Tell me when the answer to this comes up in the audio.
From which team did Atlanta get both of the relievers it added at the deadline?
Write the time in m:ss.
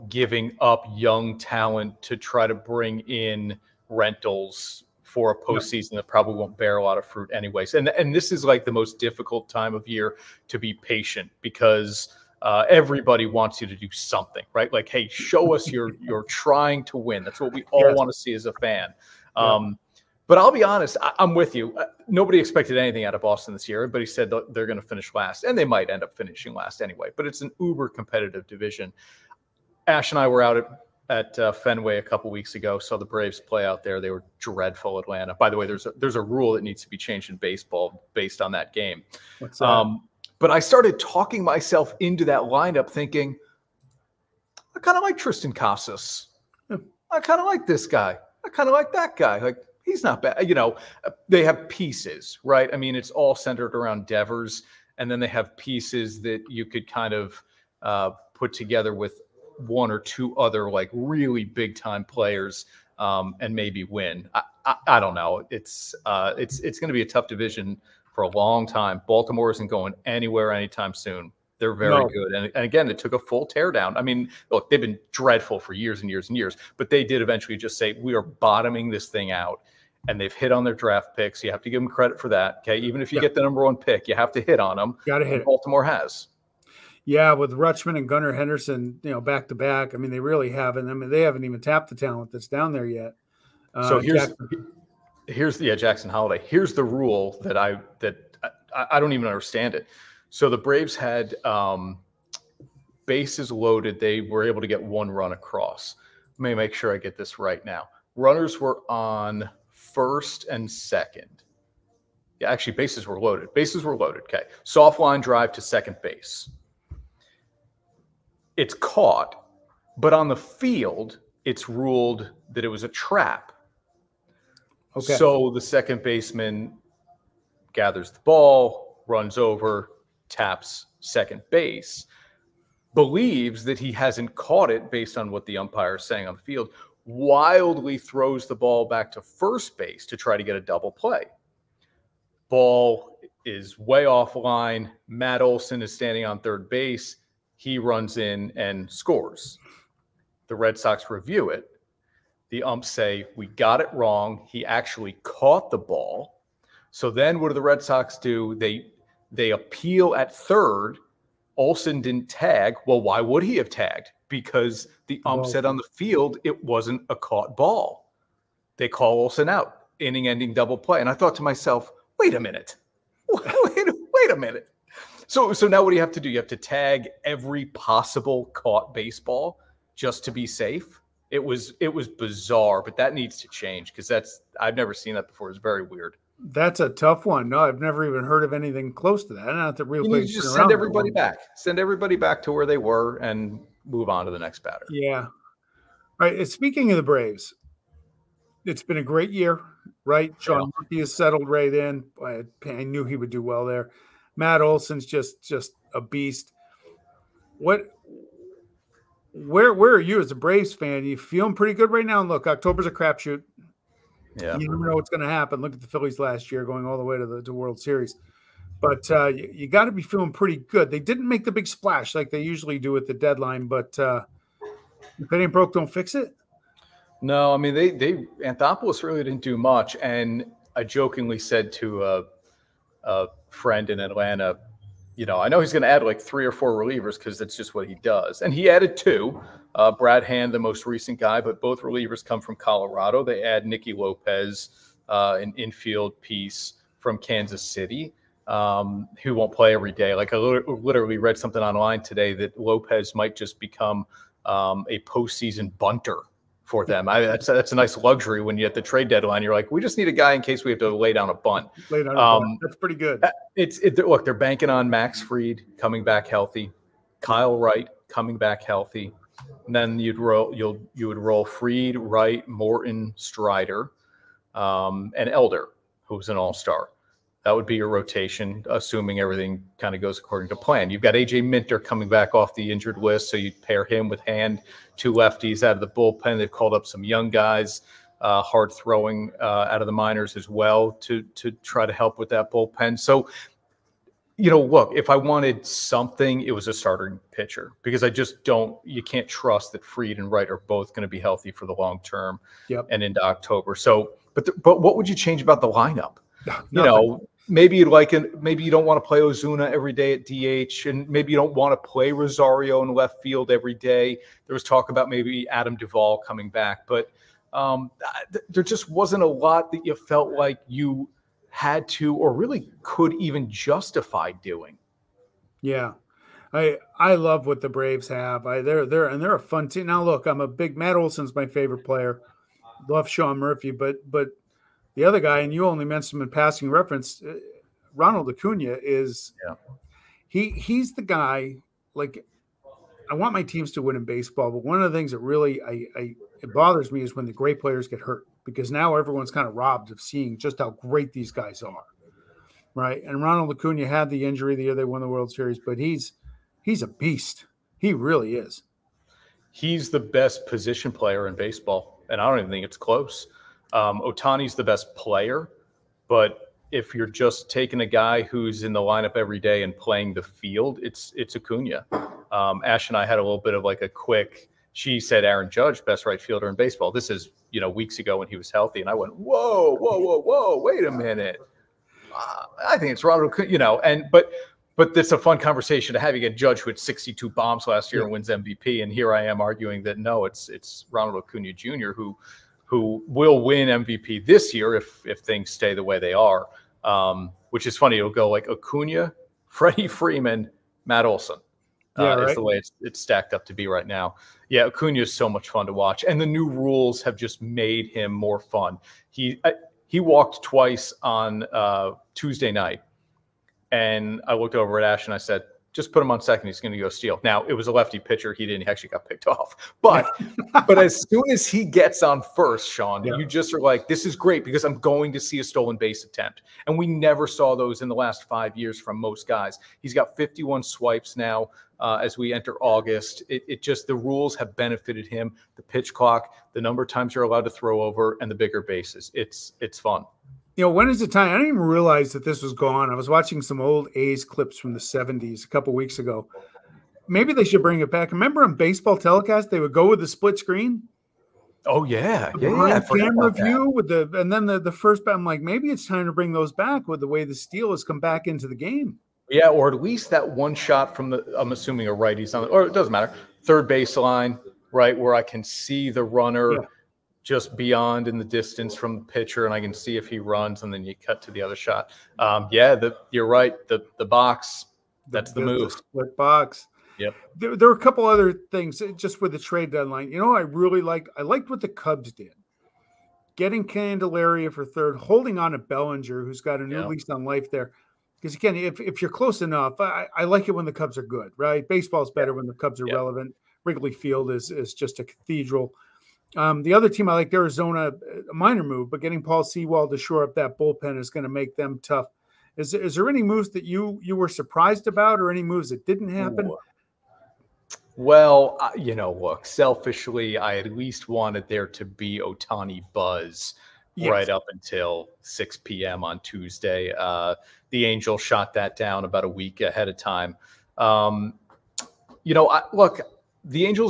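4:02.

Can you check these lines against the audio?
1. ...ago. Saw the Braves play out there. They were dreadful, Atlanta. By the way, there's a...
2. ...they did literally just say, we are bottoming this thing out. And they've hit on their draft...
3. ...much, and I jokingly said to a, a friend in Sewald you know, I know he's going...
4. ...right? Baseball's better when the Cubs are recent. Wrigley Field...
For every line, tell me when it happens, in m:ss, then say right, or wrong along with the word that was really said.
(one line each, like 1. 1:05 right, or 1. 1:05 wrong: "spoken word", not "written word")
1. 0:32 right
2. 1:16 wrong: "eventually", not "literally"
3. 3:49 wrong: "Atlanta", not "Sewald"
4. 8:11 wrong: "relevant", not "recent".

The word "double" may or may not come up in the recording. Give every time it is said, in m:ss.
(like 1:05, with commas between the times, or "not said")
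2:20, 2:50.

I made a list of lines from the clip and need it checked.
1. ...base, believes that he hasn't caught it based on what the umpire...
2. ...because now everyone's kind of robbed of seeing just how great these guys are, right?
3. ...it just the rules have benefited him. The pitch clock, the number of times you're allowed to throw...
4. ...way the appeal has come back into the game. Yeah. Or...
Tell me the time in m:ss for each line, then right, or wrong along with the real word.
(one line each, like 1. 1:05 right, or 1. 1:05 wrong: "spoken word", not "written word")
1. 2:11 right
2. 5:48 right
3. 7:13 right
4. 7:37 wrong: "steal", not "appeal".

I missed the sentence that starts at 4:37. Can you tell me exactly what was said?
That would be your rotation, assuming everything kind of goes according to plan.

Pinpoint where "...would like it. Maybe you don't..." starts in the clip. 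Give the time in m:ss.
5:07.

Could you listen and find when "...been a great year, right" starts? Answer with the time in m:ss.
3:18.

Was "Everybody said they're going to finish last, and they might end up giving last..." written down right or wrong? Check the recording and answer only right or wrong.
wrong.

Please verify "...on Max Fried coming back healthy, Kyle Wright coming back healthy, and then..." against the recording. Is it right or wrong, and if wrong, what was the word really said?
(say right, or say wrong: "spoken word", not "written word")
right.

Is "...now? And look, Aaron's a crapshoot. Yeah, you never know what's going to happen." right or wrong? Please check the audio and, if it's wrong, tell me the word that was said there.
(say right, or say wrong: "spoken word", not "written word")
wrong: "October", not "Aaron".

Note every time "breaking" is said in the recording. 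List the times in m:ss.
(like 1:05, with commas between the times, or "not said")
not said.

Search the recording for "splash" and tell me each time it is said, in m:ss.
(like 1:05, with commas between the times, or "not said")
3:41.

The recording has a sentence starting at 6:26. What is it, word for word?
You get Judge who had 62 bombs last year yeah.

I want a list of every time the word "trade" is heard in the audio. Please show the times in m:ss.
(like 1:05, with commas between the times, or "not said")
4:18, 7:59.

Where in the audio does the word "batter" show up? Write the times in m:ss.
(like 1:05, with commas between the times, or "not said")
3:14.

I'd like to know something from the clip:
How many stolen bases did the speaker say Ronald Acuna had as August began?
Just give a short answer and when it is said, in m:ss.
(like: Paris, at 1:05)
51, at 7:10.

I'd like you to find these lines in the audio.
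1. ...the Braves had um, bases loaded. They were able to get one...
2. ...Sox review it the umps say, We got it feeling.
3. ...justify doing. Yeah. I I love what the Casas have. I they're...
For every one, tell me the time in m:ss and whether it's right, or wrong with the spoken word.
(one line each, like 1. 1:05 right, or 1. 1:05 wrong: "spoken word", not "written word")
1. 1:40 right
2. 2:30 wrong: "wrong", not "feeling"
3. 5:23 wrong: "Braves", not "Casas".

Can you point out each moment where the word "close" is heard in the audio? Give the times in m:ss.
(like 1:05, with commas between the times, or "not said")
3:08, 6:02, 8:09.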